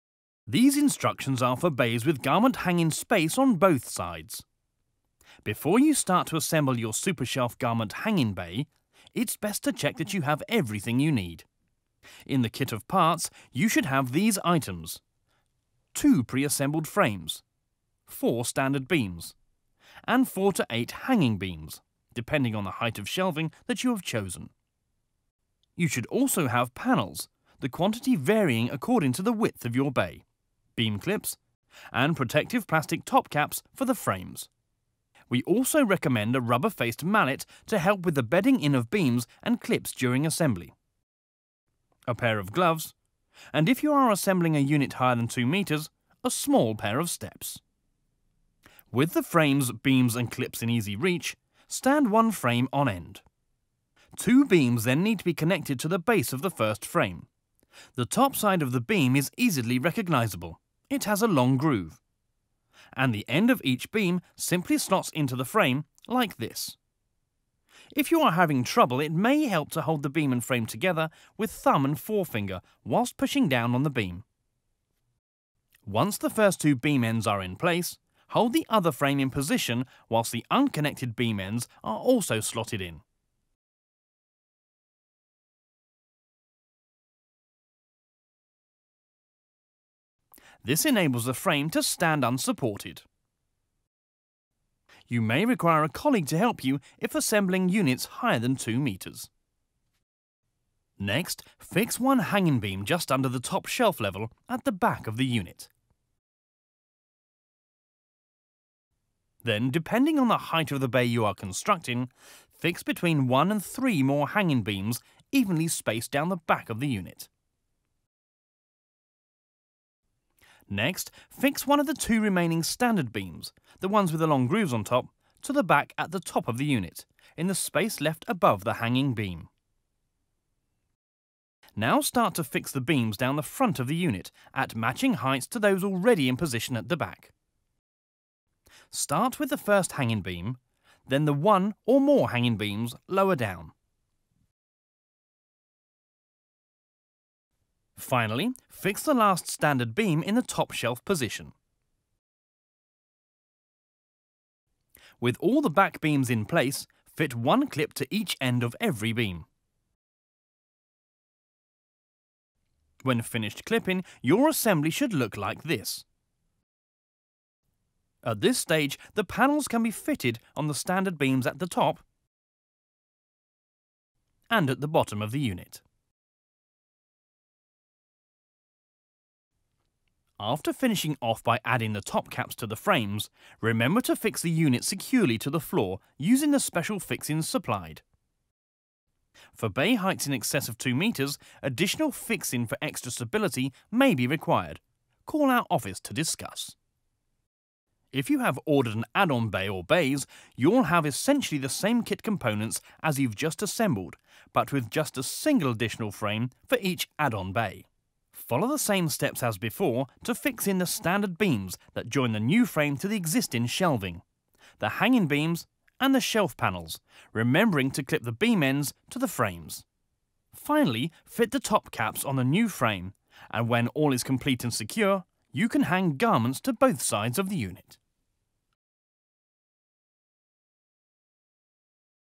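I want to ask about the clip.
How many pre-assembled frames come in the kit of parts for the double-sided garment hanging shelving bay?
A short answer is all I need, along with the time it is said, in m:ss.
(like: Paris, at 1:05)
2, at 0:15.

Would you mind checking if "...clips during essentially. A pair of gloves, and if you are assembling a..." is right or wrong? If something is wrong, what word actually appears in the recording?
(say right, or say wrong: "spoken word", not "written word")
wrong: "assembly", not "essentially".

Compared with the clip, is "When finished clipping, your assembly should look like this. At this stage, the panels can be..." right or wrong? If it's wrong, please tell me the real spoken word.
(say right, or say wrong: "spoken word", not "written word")
right.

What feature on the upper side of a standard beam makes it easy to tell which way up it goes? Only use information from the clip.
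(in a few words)
a long groove.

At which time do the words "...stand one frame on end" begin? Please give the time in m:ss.
0:51.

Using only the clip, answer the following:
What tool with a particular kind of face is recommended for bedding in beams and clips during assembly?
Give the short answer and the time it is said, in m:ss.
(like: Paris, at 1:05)
rubber-faced mallet, at 0:36.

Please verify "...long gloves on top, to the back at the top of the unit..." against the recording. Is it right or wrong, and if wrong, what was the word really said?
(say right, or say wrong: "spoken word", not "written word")
wrong: "grooves", not "gloves".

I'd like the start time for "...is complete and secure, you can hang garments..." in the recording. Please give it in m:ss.
3:44.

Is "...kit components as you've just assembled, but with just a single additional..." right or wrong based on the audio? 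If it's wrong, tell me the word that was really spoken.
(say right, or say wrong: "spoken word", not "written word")
right.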